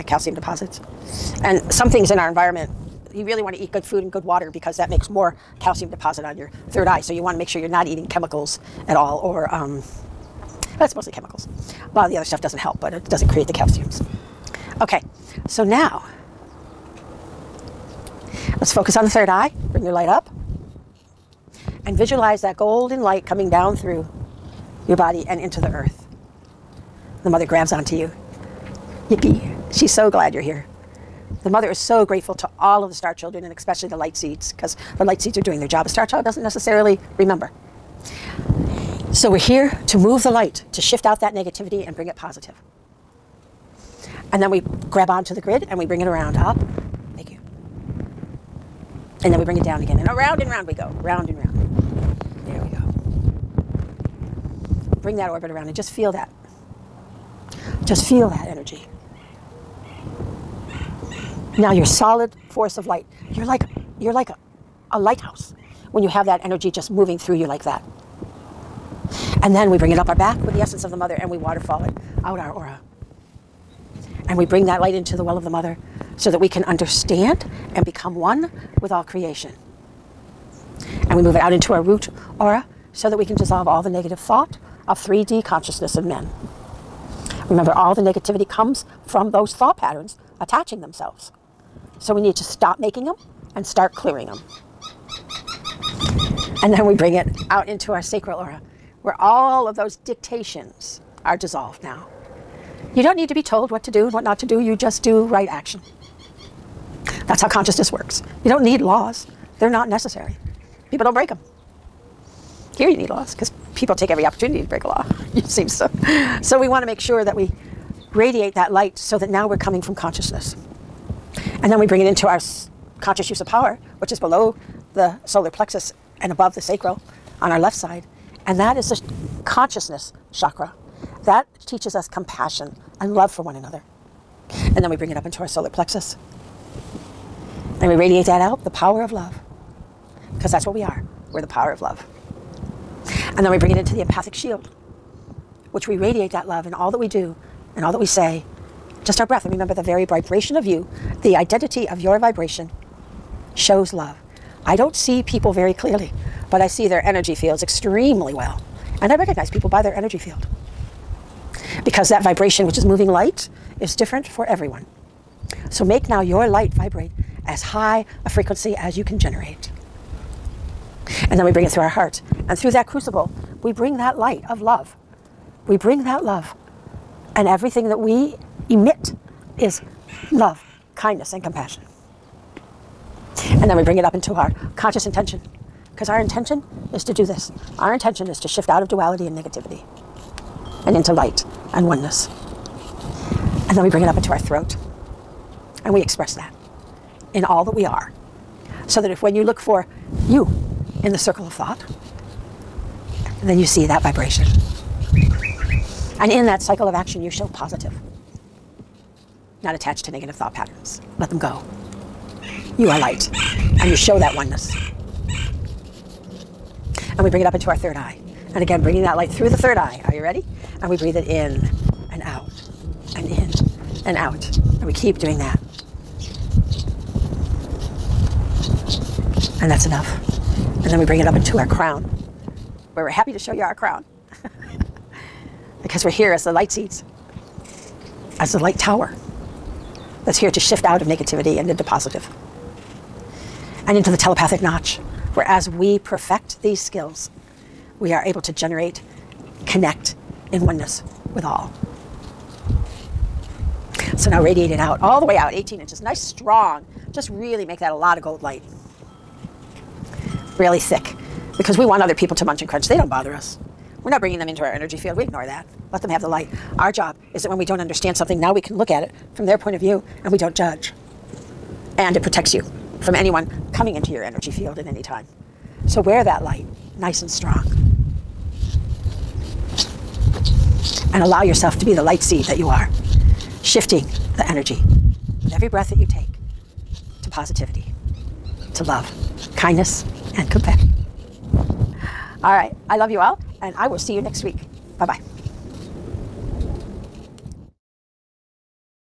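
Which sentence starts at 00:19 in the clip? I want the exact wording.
Bring your light up and visualize that golden light coming down through your body and into the earth.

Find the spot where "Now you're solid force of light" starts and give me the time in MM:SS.
01:01.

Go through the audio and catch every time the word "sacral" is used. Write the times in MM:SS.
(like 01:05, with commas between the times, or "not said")
01:38, 02:06.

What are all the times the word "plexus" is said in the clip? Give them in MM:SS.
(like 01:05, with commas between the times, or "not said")
02:05, 02:15.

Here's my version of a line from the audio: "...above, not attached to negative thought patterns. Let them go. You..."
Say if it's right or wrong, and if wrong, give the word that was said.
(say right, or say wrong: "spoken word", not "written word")
wrong: "positive", not "above".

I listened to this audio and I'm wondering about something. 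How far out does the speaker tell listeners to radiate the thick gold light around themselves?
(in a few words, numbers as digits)
18 inches.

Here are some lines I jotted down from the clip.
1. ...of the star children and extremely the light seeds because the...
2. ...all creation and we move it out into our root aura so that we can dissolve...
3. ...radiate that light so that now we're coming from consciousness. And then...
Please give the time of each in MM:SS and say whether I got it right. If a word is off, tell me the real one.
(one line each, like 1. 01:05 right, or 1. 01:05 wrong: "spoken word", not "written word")
1. 00:32 wrong: "especially", not "extremely"
2. 01:18 right
3. 01:58 right.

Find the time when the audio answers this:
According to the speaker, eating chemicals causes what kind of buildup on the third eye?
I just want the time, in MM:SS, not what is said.
00:00.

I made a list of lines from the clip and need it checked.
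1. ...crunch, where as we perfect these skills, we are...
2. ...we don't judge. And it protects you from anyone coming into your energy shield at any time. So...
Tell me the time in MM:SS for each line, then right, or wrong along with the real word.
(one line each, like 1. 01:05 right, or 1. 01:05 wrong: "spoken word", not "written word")
1. 04:04 wrong: "notch", not "crunch"
2. 04:30 wrong: "field", not "shield".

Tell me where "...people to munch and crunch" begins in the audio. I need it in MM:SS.
04:22.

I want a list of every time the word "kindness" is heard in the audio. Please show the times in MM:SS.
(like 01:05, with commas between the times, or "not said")
03:00, 04:49.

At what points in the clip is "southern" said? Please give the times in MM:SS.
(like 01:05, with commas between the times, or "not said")
not said.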